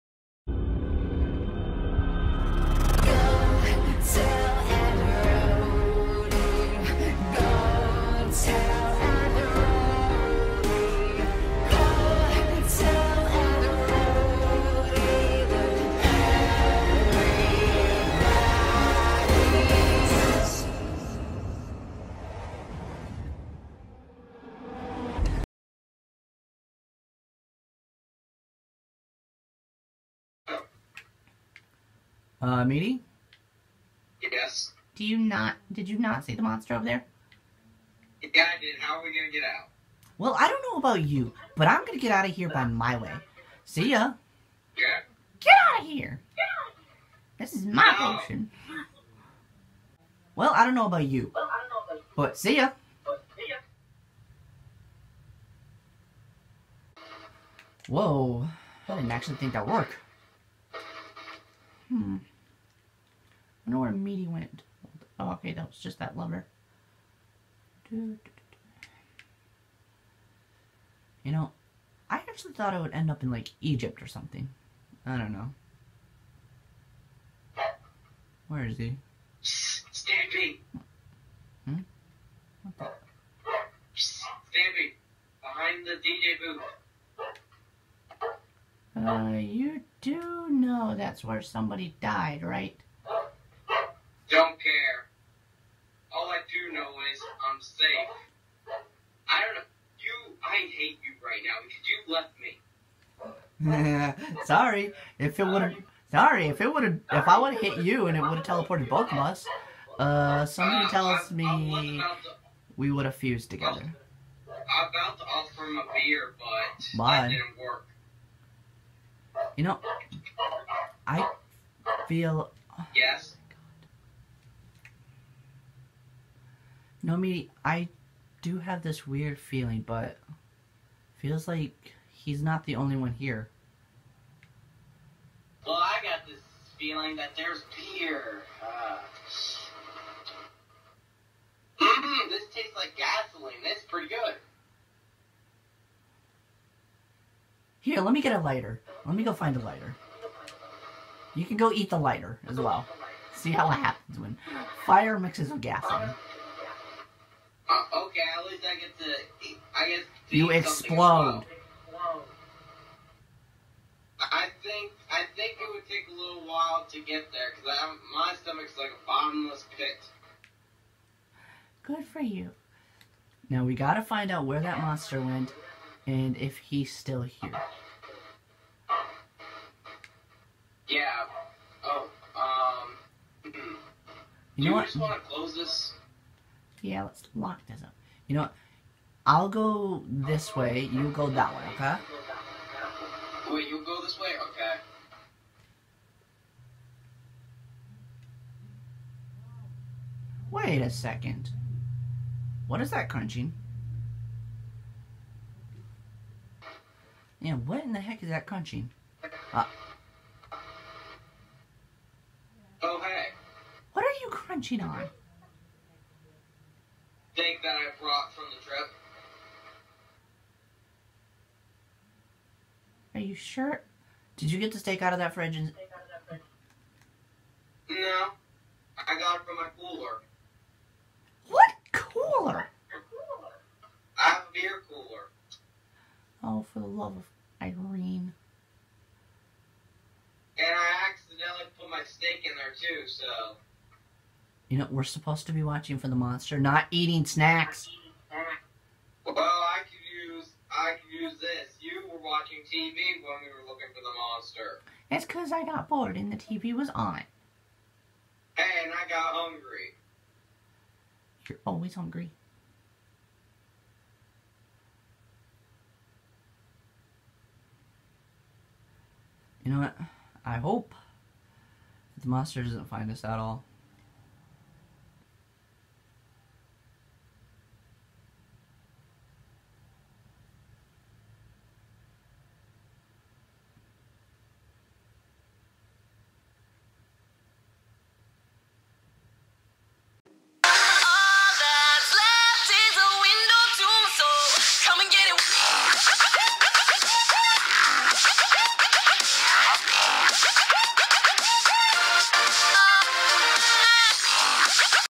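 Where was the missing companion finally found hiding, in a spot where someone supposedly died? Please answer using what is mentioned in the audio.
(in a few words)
Behind the DJ booth.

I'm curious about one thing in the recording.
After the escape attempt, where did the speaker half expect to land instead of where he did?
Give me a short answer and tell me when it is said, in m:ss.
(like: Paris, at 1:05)
Egypt, at 1:13.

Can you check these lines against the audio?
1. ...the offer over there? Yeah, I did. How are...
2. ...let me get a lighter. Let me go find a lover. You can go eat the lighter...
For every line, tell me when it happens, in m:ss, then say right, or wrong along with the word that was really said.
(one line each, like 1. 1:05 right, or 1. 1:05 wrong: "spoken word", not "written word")
1. 0:36 wrong: "monster", not "offer"
2. 2:28 wrong: "lighter", not "lover".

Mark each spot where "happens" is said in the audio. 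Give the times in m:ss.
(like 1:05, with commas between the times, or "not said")
2:33.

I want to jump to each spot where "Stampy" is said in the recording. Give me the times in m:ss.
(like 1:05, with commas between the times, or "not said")
1:19, 1:23.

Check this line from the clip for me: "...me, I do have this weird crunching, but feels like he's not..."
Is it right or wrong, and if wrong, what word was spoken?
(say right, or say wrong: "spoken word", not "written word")
wrong: "feeling", not "crunching".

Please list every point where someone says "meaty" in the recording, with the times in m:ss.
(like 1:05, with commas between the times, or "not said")
0:32, 1:03.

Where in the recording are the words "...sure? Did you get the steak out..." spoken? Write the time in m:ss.
3:43.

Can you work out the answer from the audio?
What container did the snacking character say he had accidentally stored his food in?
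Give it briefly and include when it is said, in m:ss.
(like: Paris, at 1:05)
Beer cooler, at 3:54.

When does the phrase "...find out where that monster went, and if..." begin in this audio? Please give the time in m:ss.
2:54.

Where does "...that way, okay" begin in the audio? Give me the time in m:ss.
3:11.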